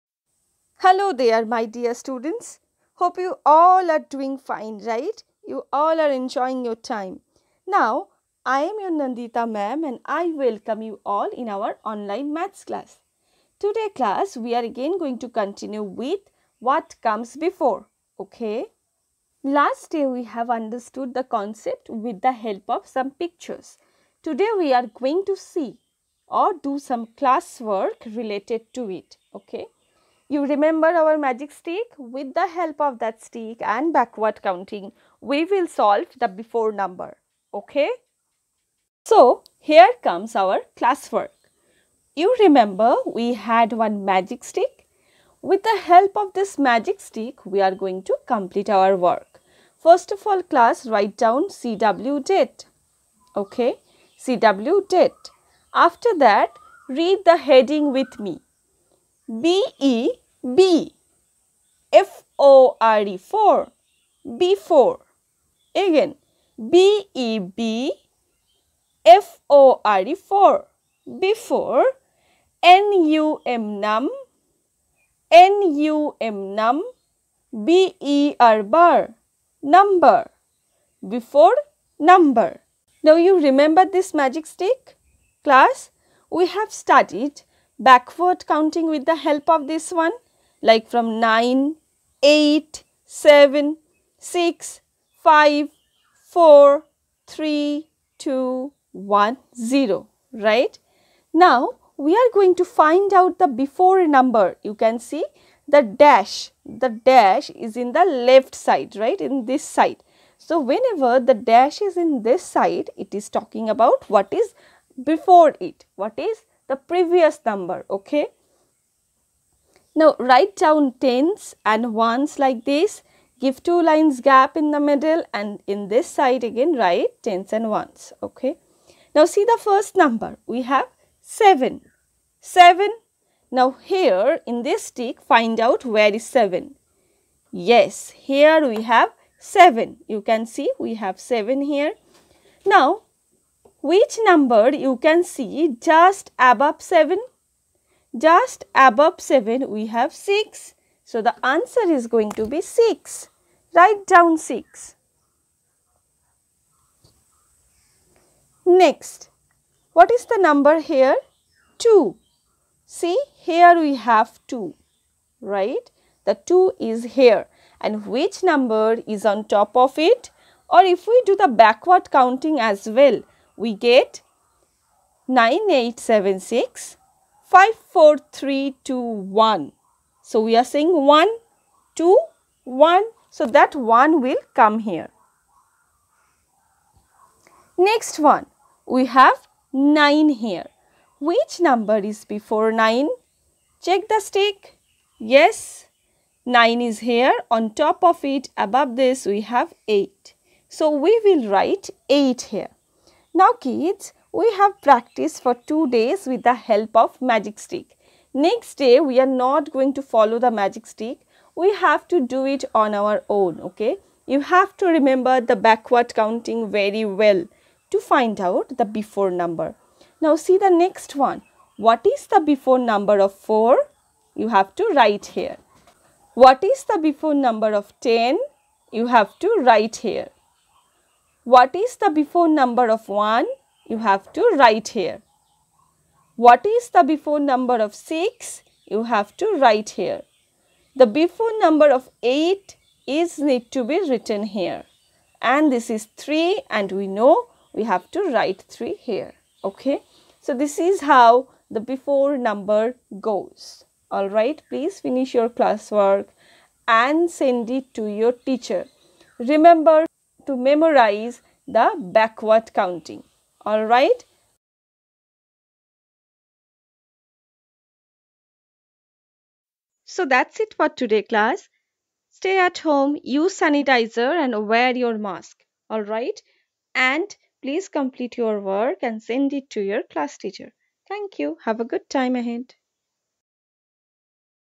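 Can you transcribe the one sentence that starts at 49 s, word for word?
First of all, class, write down CW date.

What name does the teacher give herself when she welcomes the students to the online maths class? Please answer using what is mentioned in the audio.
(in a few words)
Nandita ma'am.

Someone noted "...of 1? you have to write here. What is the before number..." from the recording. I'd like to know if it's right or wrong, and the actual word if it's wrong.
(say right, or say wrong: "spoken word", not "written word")
right.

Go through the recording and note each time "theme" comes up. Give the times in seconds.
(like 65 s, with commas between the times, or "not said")
not said.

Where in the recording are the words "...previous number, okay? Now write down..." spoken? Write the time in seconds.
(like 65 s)
116 s.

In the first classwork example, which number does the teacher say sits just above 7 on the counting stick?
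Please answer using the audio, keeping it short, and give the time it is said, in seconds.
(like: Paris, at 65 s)
6, at 148 s.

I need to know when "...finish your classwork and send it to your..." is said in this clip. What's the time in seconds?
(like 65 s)
255 s.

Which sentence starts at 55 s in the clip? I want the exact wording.
After that, read the heading with me.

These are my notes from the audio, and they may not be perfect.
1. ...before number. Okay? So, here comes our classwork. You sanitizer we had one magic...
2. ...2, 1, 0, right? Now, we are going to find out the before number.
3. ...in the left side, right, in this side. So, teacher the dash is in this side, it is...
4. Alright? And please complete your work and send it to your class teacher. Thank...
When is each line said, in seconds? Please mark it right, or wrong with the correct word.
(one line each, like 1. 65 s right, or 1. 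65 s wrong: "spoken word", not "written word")
1. 36 s wrong: "remember", not "sanitizer"
2. 98 s right
3. 107 s wrong: "whenever", not "teacher"
4. 275 s right.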